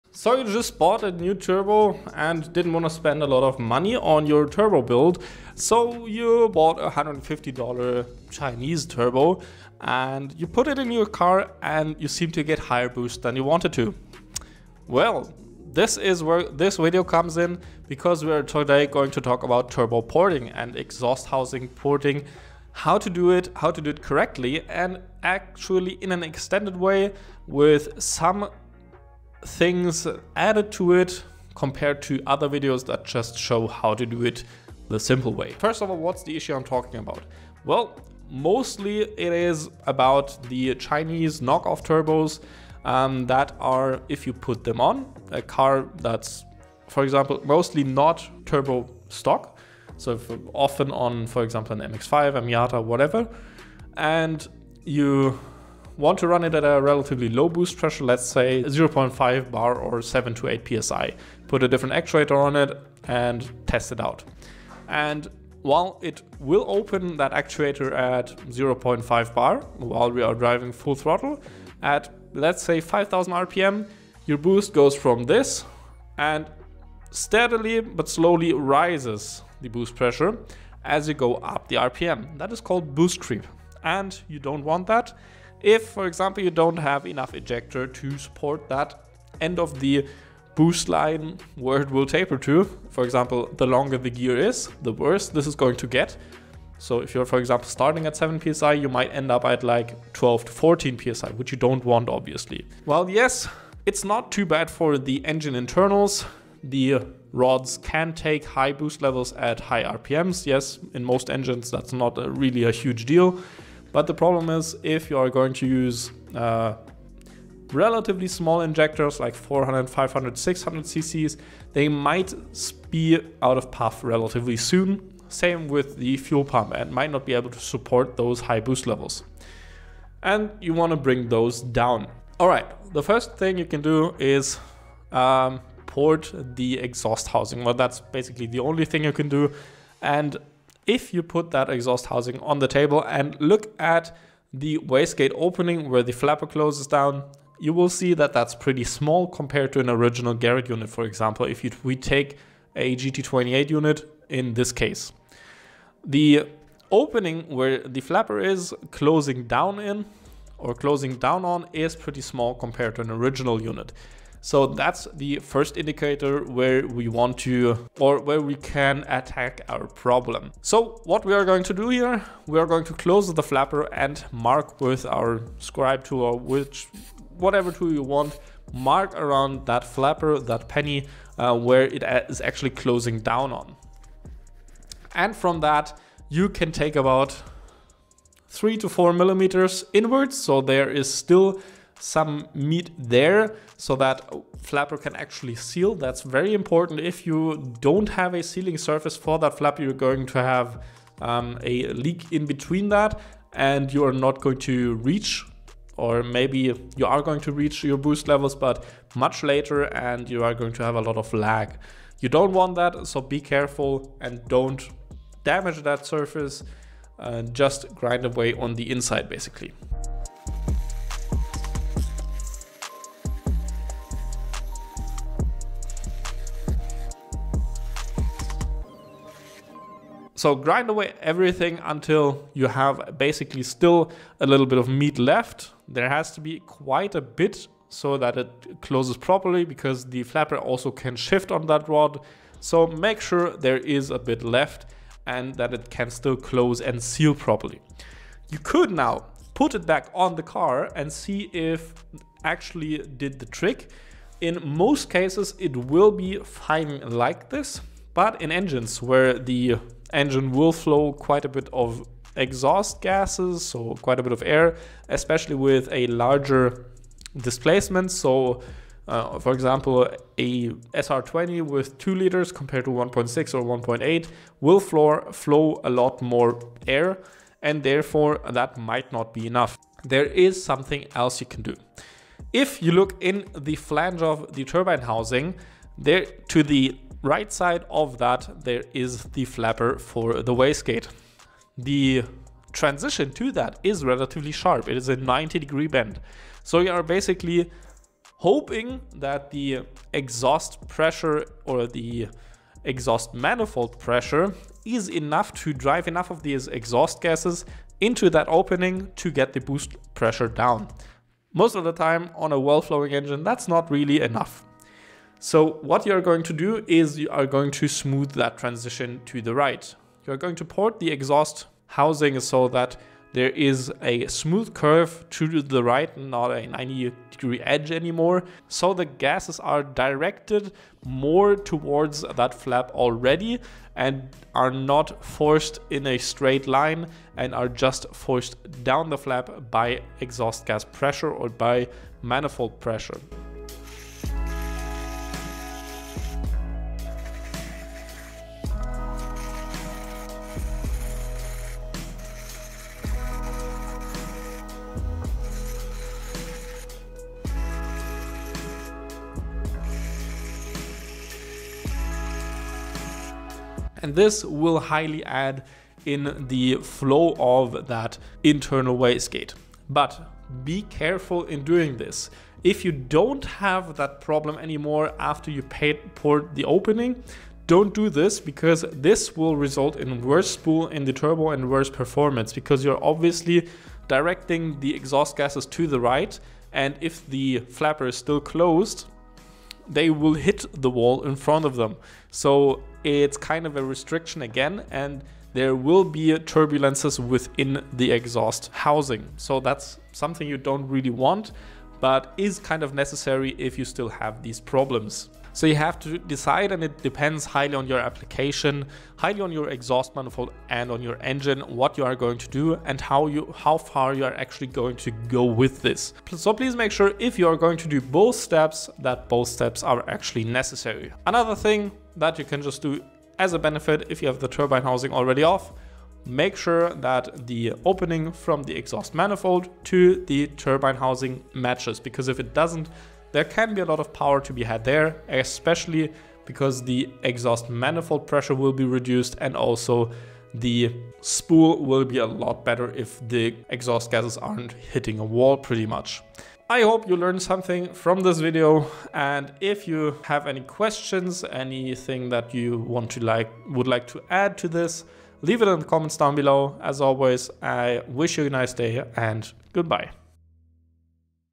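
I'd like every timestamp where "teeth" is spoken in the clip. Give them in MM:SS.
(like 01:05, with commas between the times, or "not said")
not said.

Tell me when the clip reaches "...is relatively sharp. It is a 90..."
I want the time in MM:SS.
04:53.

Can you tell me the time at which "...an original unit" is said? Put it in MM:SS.
02:43.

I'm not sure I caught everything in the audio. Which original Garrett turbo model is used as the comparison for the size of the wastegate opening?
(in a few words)
GT28.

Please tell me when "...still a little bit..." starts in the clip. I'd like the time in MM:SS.
03:53.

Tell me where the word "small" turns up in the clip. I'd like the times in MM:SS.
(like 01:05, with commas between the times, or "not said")
01:58, 02:28, 02:42.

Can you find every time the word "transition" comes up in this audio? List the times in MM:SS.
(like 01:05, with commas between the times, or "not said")
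04:52, 05:18.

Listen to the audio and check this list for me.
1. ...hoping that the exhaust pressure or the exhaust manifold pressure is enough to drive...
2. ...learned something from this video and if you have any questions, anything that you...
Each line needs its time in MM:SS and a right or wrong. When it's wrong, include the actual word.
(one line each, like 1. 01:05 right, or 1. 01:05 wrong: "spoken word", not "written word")
1. 04:58 right
2. 07:27 right.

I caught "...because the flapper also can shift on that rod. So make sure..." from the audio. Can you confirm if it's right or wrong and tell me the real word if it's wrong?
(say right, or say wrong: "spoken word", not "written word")
right.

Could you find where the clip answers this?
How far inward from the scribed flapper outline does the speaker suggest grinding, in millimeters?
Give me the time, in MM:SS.
03:08.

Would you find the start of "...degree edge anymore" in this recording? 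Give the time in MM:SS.
05:27.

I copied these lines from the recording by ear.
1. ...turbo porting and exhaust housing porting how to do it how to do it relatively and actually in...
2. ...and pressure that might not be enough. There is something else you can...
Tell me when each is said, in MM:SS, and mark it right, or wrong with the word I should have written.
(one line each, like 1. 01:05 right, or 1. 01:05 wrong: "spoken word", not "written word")
1. 00:19 wrong: "correctly", not "relatively"
2. 04:37 wrong: "therefore", not "pressure".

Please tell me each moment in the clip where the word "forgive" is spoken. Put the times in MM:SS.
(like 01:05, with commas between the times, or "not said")
not said.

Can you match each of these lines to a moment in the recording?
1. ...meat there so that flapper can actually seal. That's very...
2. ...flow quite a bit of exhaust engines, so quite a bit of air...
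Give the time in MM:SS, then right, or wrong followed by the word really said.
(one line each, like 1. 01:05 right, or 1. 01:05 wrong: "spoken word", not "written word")
1. 03:12 right
2. 04:20 wrong: "gases", not "engines".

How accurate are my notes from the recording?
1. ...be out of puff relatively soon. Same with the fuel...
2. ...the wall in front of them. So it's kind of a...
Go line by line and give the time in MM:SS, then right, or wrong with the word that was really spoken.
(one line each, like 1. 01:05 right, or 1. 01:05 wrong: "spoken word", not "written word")
1. 02:02 right
2. 06:30 right.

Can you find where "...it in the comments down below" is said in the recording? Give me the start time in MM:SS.
07:35.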